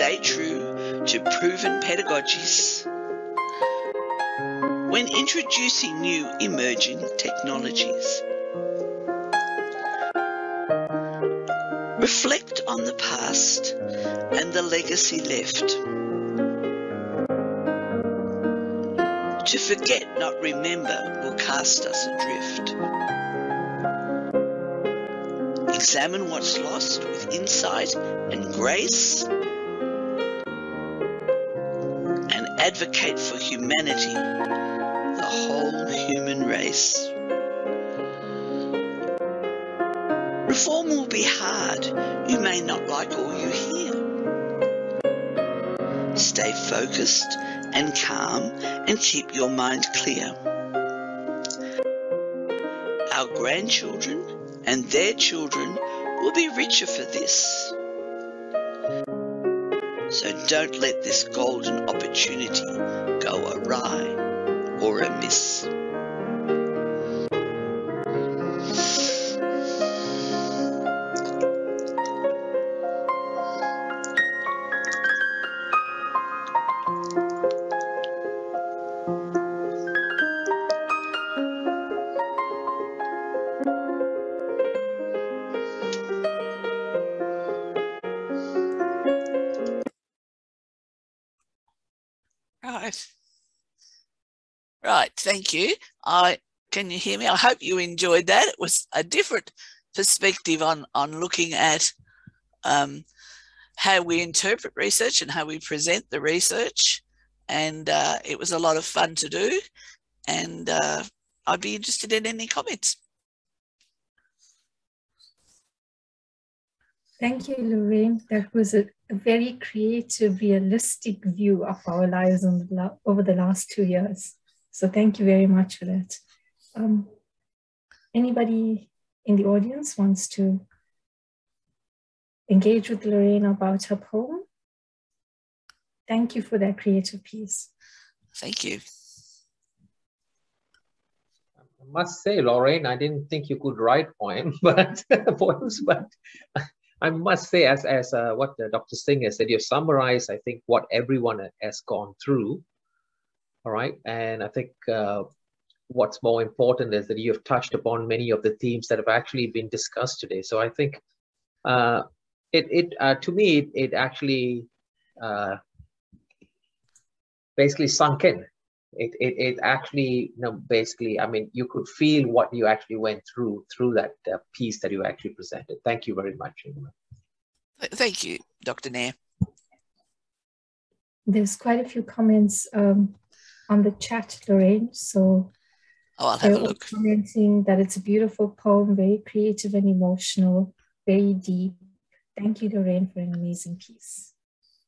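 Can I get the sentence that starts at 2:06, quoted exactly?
Um, anybody in the audience wants to engage with Lorraine about her poem?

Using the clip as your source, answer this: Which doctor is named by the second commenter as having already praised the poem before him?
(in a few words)
Dr. Singh.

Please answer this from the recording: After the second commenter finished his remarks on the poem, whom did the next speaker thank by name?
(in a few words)
Dr. Nair.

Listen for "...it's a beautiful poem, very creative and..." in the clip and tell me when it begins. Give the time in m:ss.
3:07.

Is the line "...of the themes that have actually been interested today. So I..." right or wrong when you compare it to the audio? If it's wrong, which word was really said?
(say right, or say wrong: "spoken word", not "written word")
wrong: "discussed", not "interested".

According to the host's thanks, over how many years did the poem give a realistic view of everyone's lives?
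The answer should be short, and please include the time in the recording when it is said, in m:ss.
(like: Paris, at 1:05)
2, at 2:03.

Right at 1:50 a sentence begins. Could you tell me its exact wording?
And uh, I'd be interested in any comments.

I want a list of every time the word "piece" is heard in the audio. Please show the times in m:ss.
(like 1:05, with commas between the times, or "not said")
2:17, 2:54, 3:13.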